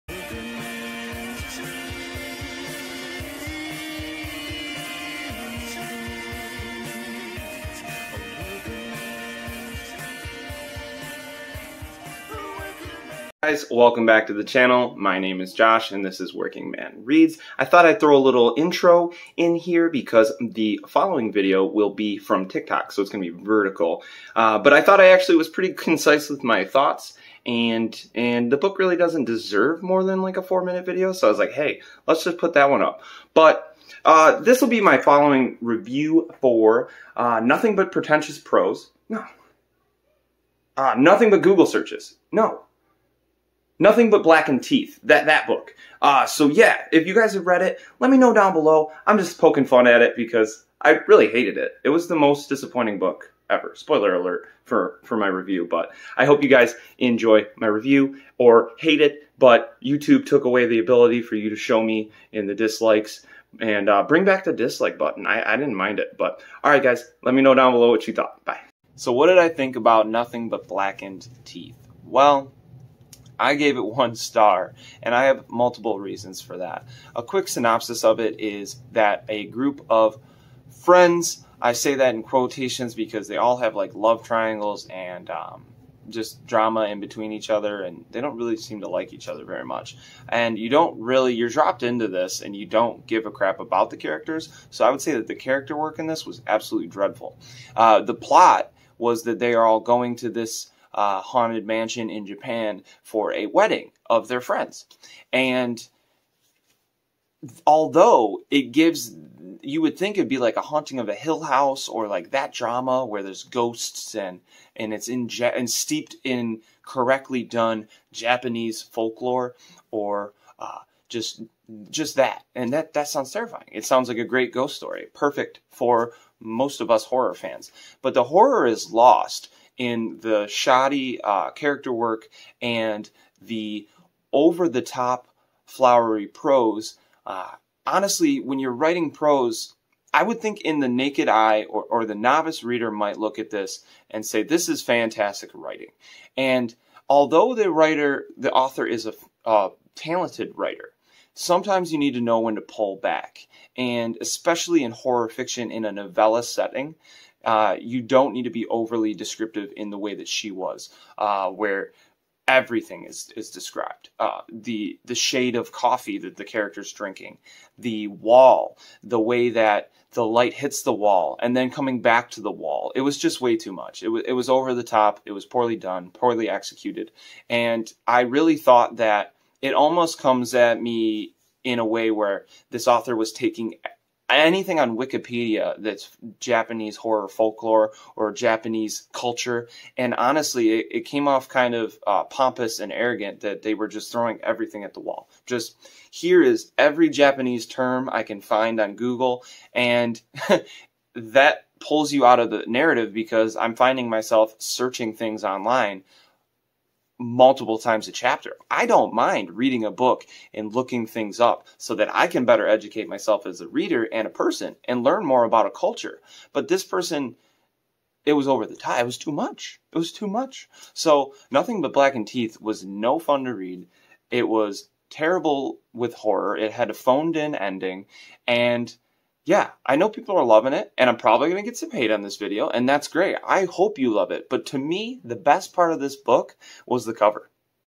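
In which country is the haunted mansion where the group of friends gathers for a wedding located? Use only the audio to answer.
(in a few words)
Japan.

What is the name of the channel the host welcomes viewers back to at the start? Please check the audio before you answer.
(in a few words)
Working Man Reads.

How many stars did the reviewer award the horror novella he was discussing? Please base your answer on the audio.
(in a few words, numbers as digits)
1.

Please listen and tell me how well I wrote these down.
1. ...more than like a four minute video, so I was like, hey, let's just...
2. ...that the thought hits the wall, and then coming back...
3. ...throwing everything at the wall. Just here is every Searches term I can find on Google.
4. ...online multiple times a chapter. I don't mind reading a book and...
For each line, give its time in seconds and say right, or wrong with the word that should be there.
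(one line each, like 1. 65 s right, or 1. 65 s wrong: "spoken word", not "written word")
1. 29 s right
2. 169 s wrong: "light", not "thought"
3. 194 s wrong: "Japanese", not "Searches"
4. 205 s right.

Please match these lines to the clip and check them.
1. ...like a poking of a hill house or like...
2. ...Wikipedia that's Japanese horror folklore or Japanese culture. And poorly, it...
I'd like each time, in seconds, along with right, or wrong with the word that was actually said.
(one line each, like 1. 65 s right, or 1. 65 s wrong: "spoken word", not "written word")
1. 110 s wrong: "haunting", not "poking"
2. 184 s wrong: "honestly", not "poorly".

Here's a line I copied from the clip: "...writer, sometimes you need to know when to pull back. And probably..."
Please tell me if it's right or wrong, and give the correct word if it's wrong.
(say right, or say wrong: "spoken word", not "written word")
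wrong: "especially", not "probably".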